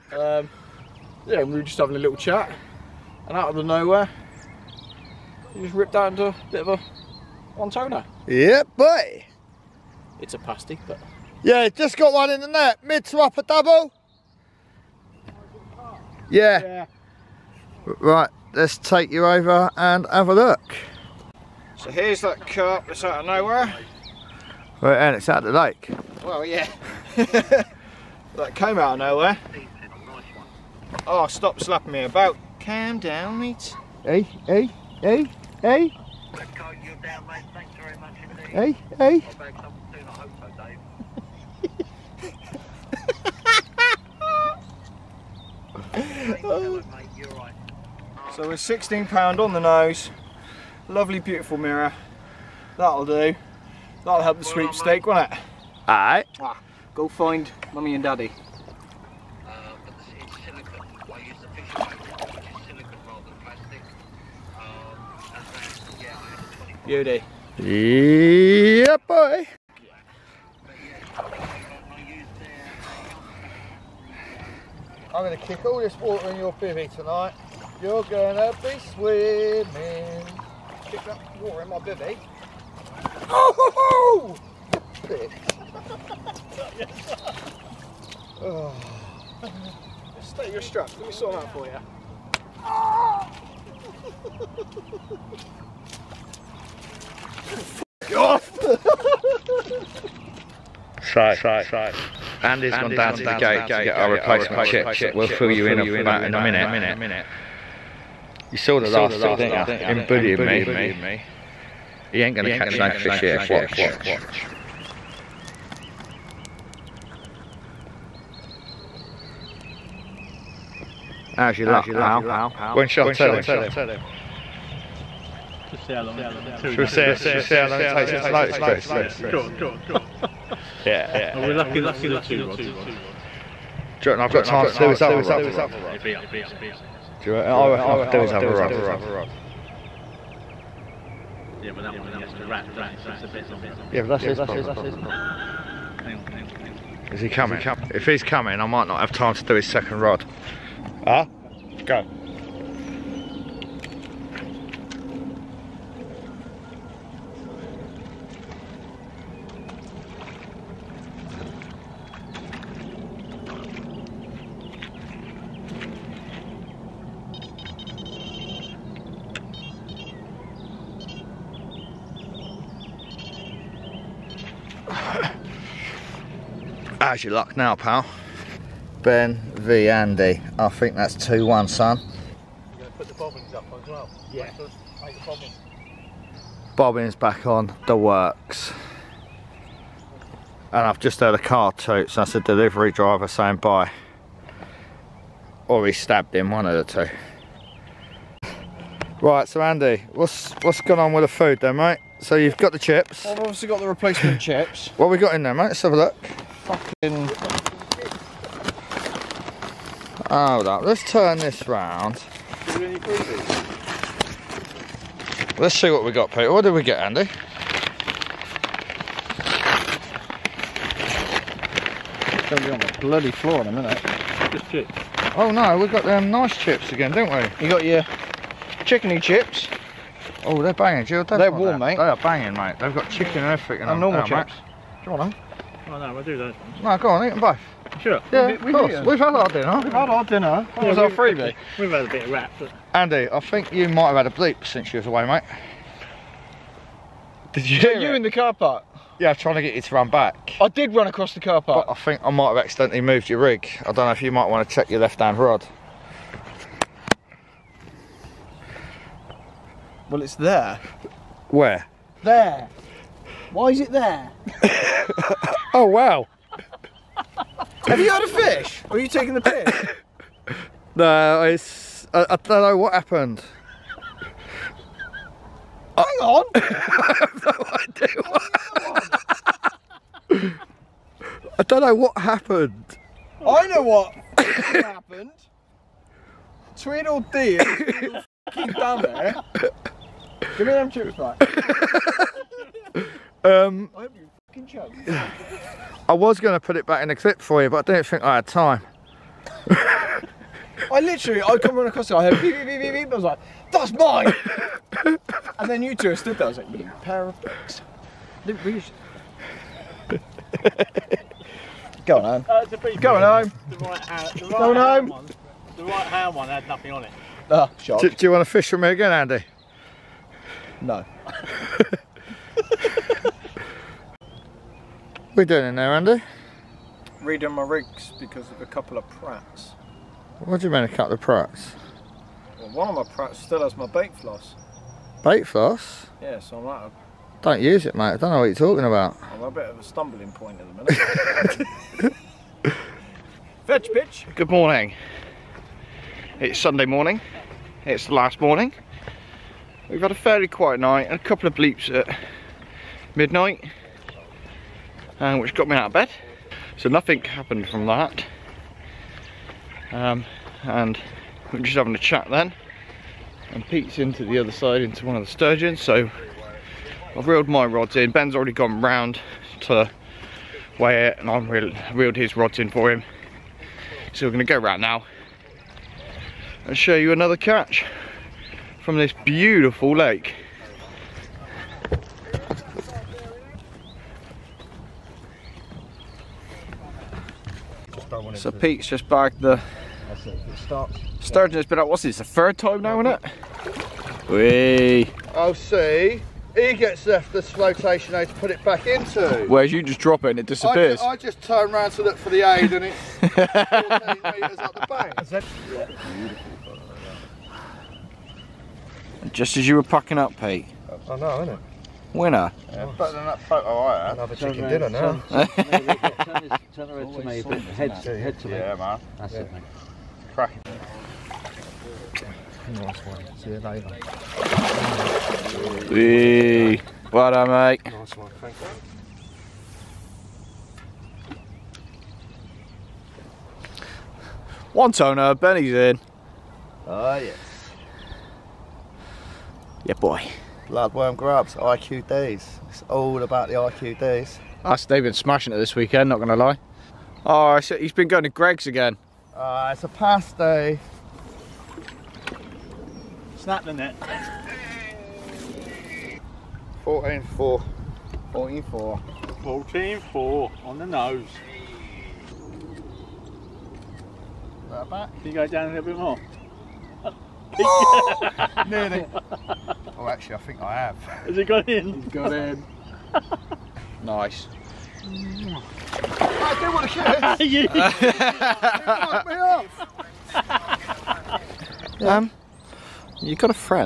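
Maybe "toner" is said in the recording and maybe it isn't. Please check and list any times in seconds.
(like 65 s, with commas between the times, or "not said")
7 s, 434 s.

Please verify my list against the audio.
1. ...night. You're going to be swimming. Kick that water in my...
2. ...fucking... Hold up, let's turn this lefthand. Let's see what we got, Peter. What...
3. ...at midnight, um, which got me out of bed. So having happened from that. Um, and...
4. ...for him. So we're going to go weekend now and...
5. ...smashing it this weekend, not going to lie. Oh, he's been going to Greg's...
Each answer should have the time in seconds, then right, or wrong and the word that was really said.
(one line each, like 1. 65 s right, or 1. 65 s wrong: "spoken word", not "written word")
1. 76 s wrong: "tonight", not "night"
2. 206 s wrong: "round", not "lefthand"
3. 351 s wrong: "nothing", not "having"
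4. 372 s wrong: "round", not "weekend"
5. 445 s right.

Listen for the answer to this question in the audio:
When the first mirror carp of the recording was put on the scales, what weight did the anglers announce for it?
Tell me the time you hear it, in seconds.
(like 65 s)
48 s.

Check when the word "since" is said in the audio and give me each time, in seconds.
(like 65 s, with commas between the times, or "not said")
244 s.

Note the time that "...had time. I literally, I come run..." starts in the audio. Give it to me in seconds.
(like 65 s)
298 s.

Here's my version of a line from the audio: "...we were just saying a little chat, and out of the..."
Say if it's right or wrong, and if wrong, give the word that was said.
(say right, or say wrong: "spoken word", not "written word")
wrong: "having", not "saying".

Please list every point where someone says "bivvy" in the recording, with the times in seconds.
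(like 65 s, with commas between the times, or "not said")
76 s, 81 s.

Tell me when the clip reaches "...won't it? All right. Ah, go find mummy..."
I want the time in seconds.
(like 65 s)
55 s.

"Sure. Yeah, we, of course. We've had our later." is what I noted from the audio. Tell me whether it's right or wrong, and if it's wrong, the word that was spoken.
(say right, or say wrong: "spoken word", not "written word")
wrong: "dinner", not "later".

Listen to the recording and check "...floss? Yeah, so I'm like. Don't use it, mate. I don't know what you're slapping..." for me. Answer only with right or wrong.
wrong.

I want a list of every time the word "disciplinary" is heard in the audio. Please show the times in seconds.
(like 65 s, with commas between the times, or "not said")
not said.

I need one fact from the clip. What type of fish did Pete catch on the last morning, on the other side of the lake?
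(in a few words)
Sturgeon.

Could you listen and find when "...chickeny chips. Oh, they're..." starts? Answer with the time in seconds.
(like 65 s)
228 s.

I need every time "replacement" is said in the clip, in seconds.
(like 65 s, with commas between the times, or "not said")
104 s, 203 s.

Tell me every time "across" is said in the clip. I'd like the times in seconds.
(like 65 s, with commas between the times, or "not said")
251 s, 301 s.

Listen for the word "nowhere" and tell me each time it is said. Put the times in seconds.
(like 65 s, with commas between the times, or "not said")
3 s, 23 s, 28 s.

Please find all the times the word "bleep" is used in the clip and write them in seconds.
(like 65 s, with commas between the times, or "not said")
244 s, 351 s.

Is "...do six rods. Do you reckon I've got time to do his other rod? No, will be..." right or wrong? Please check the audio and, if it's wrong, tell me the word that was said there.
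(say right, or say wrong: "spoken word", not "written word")
wrong: "two", not "six".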